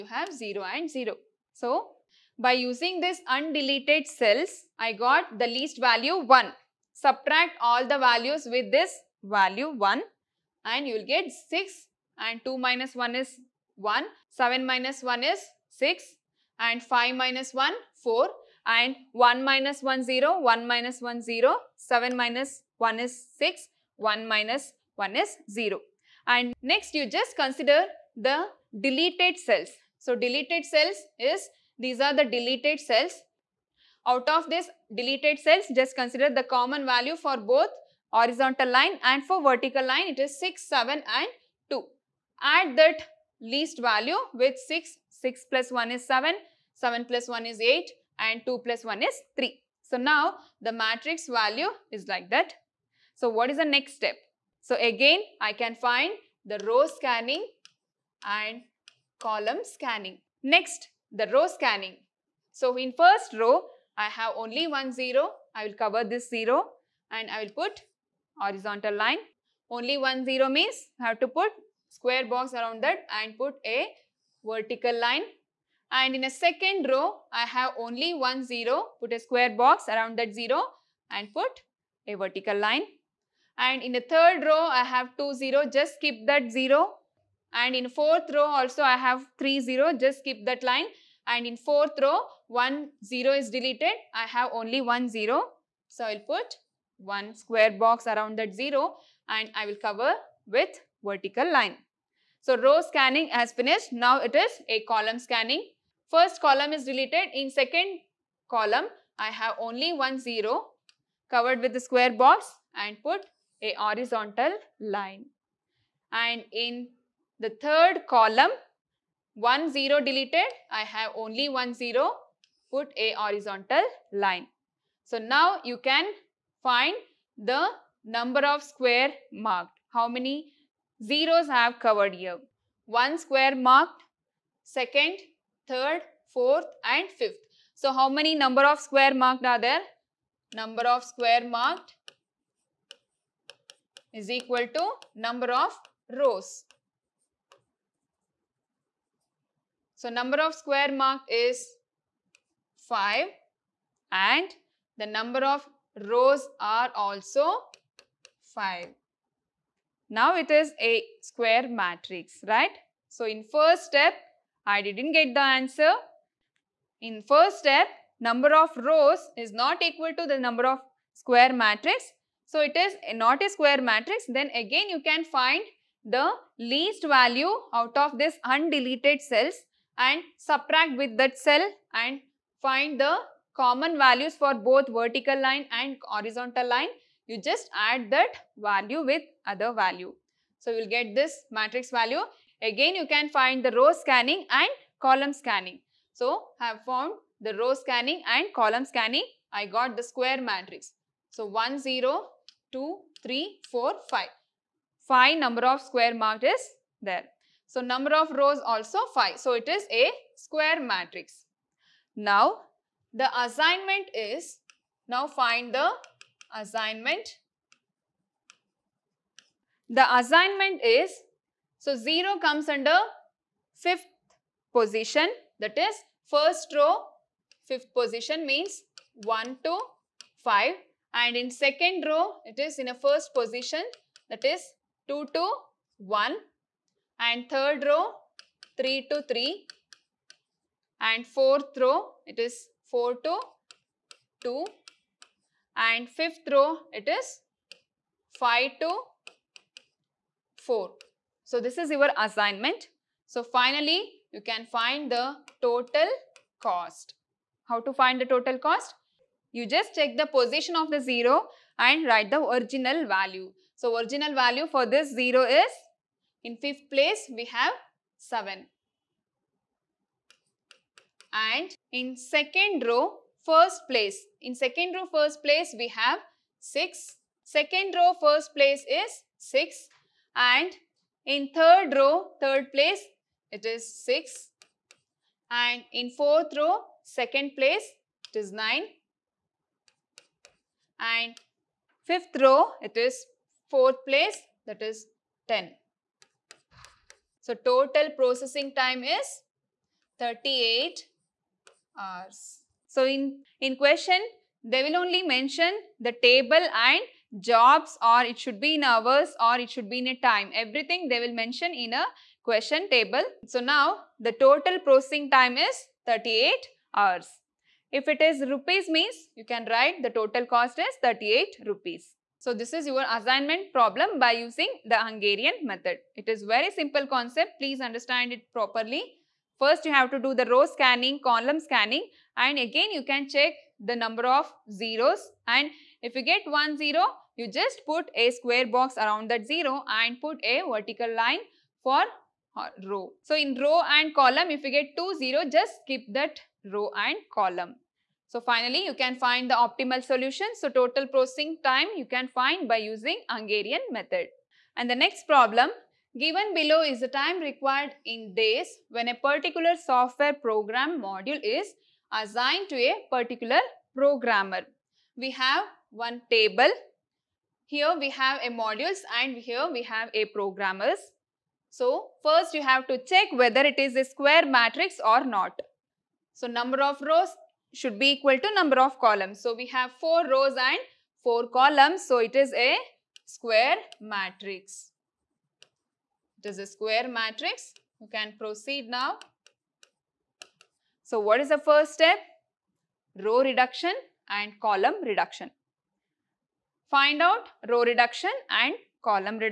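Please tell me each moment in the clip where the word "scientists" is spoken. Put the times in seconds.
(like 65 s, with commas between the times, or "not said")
not said.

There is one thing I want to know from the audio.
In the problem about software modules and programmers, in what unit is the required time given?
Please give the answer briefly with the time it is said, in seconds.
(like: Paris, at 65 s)
days, at 357 s.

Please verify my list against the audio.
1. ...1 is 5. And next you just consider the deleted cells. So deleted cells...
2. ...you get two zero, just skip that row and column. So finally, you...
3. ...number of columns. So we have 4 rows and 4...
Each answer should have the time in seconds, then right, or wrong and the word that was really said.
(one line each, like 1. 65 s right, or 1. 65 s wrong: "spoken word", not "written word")
1. 24 s wrong: "0", not "5"
2. 344 s right
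3. 378 s right.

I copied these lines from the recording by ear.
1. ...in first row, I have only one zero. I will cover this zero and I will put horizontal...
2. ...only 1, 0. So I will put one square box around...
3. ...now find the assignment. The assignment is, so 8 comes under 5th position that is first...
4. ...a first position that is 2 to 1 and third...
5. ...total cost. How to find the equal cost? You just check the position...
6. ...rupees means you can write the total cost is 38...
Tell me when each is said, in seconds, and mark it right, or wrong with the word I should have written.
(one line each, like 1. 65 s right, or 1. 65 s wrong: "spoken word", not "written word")
1. 62 s right
2. 94 s right
3. 215 s wrong: "0", not "8"
4. 232 s right
5. 255 s wrong: "total", not "equal"
6. 318 s right.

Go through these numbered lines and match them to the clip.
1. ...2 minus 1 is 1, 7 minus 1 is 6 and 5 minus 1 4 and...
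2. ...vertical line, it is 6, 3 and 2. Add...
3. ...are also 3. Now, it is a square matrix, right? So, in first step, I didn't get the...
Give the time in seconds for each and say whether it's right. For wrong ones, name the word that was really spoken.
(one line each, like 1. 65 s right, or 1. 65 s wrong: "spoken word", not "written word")
1. 12 s right
2. 39 s wrong: "7", not "3"
3. 156 s wrong: "5", not "3".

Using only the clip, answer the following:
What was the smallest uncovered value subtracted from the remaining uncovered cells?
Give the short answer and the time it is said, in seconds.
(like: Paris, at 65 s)
1, at 4 s.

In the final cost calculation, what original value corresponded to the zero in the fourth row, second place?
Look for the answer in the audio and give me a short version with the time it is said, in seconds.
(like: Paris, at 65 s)
9, at 288 s.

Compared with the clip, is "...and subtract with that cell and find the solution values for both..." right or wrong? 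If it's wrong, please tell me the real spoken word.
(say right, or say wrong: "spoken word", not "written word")
wrong: "common", not "solution".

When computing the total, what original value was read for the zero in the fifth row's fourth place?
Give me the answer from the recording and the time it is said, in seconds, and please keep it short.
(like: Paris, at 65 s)
10, at 294 s.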